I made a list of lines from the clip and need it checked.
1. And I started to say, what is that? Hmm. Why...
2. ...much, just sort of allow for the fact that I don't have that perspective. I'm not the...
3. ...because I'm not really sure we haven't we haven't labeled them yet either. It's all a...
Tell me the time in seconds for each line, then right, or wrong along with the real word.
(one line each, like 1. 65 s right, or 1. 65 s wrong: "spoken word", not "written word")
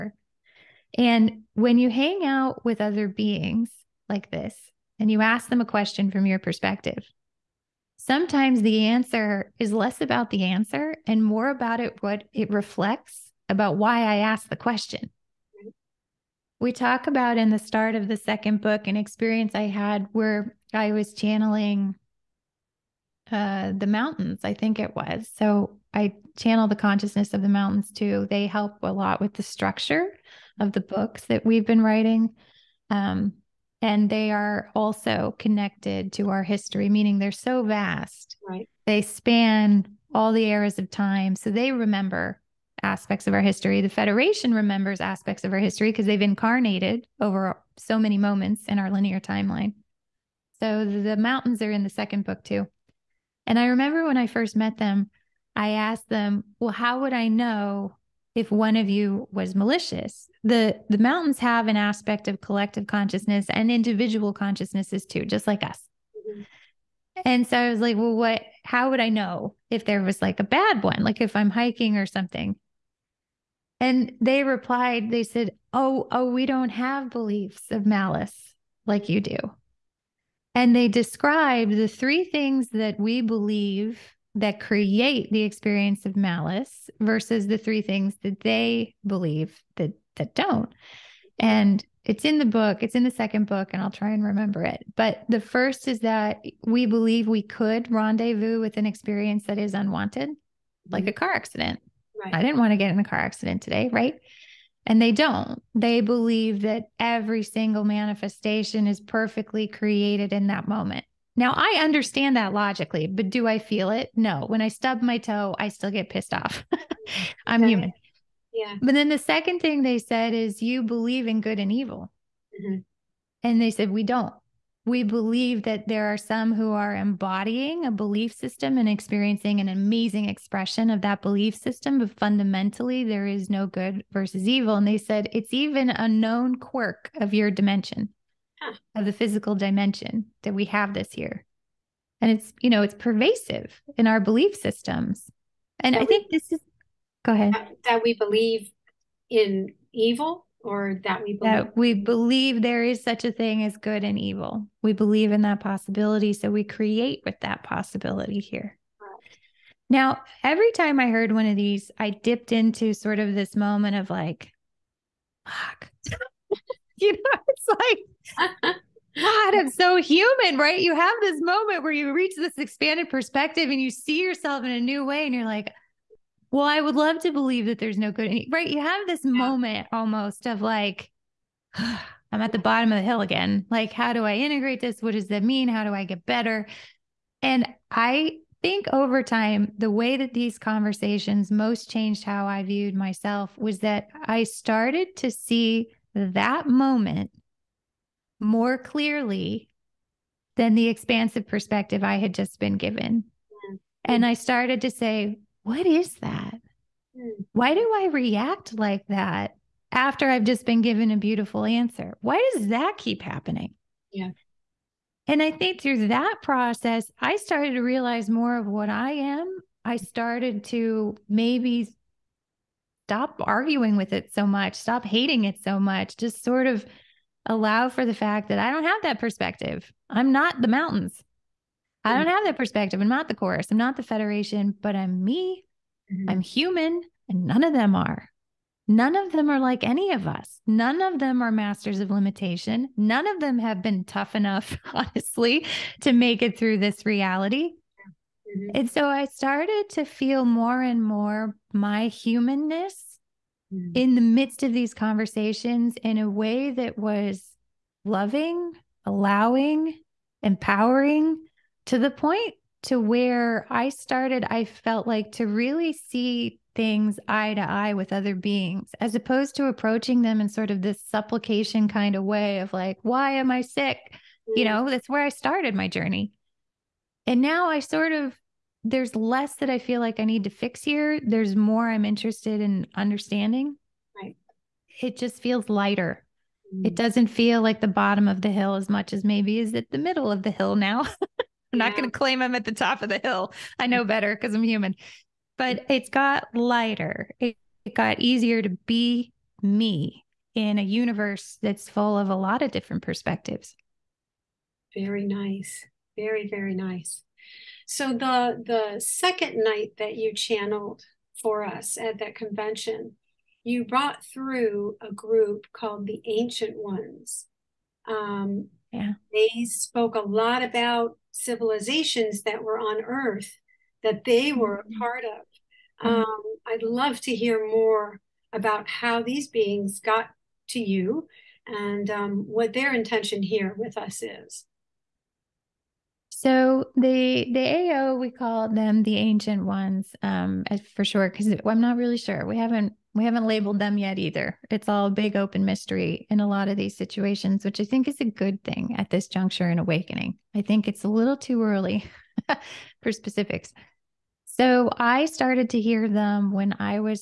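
1. 204 s right
2. 225 s right
3. 341 s right.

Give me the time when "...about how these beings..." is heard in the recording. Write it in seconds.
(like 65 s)
328 s.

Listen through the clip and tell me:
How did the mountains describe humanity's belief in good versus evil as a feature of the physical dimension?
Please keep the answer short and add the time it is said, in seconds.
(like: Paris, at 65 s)
a known quirk, at 136 s.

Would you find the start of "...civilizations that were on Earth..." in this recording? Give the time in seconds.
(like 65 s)
321 s.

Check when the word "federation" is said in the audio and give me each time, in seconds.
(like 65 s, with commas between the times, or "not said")
43 s, 234 s.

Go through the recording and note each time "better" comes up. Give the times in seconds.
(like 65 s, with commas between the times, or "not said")
186 s, 294 s.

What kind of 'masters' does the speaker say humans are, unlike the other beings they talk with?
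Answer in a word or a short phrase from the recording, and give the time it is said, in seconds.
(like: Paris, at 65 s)
masters of limitation, at 241 s.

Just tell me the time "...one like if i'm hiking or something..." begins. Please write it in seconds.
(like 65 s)
70 s.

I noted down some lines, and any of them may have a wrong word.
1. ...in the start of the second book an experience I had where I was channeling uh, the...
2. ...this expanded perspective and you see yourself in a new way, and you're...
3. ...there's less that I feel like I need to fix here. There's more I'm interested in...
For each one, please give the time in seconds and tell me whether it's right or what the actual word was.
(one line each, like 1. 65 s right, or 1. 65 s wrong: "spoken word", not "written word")
1. 17 s right
2. 172 s right
3. 278 s right.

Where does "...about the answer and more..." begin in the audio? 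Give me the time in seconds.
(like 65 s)
9 s.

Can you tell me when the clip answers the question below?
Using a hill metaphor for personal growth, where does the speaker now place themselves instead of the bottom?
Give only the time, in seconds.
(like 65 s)
289 s.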